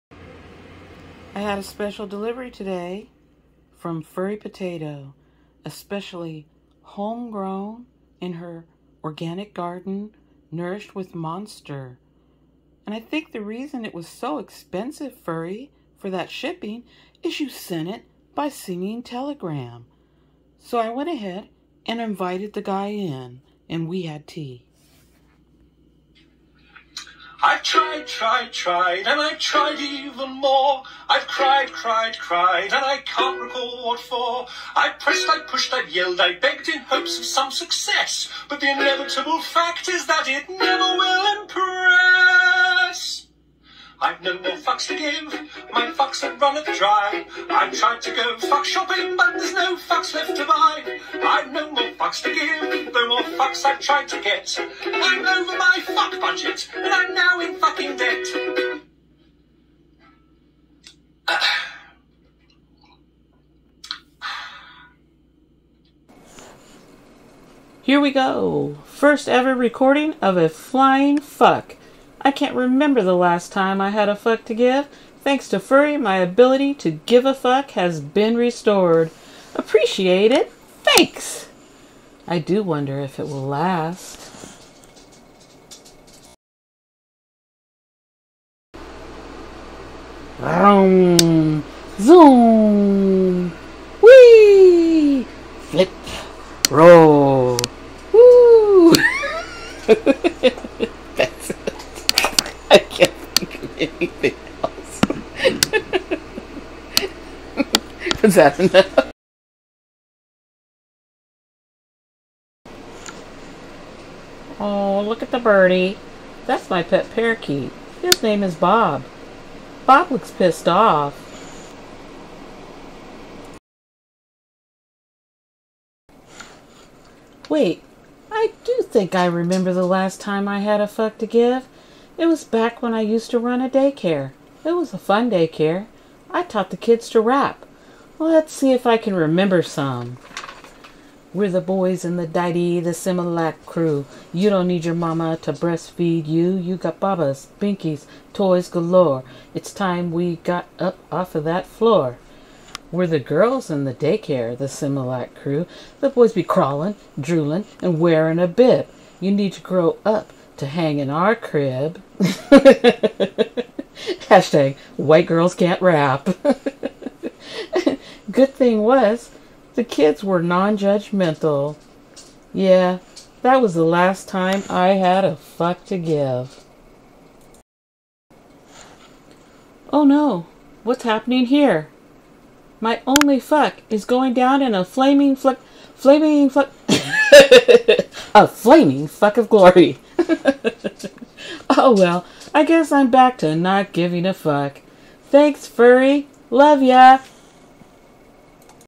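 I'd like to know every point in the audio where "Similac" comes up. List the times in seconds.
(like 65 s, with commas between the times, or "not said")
142 s, 154 s.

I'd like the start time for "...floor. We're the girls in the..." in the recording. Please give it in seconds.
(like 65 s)
151 s.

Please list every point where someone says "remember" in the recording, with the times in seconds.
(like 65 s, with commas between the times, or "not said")
72 s, 129 s, 139 s.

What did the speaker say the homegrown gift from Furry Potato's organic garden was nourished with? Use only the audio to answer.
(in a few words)
Monster.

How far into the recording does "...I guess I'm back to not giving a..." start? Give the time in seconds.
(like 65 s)
192 s.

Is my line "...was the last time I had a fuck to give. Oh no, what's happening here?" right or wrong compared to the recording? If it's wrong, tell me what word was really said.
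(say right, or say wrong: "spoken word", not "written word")
right.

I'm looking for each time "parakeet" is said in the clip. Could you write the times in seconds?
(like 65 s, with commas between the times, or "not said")
117 s.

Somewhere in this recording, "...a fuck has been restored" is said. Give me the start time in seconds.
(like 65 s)
77 s.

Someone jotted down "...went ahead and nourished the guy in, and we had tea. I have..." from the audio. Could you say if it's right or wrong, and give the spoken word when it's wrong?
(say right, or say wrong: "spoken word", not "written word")
wrong: "invited", not "nourished".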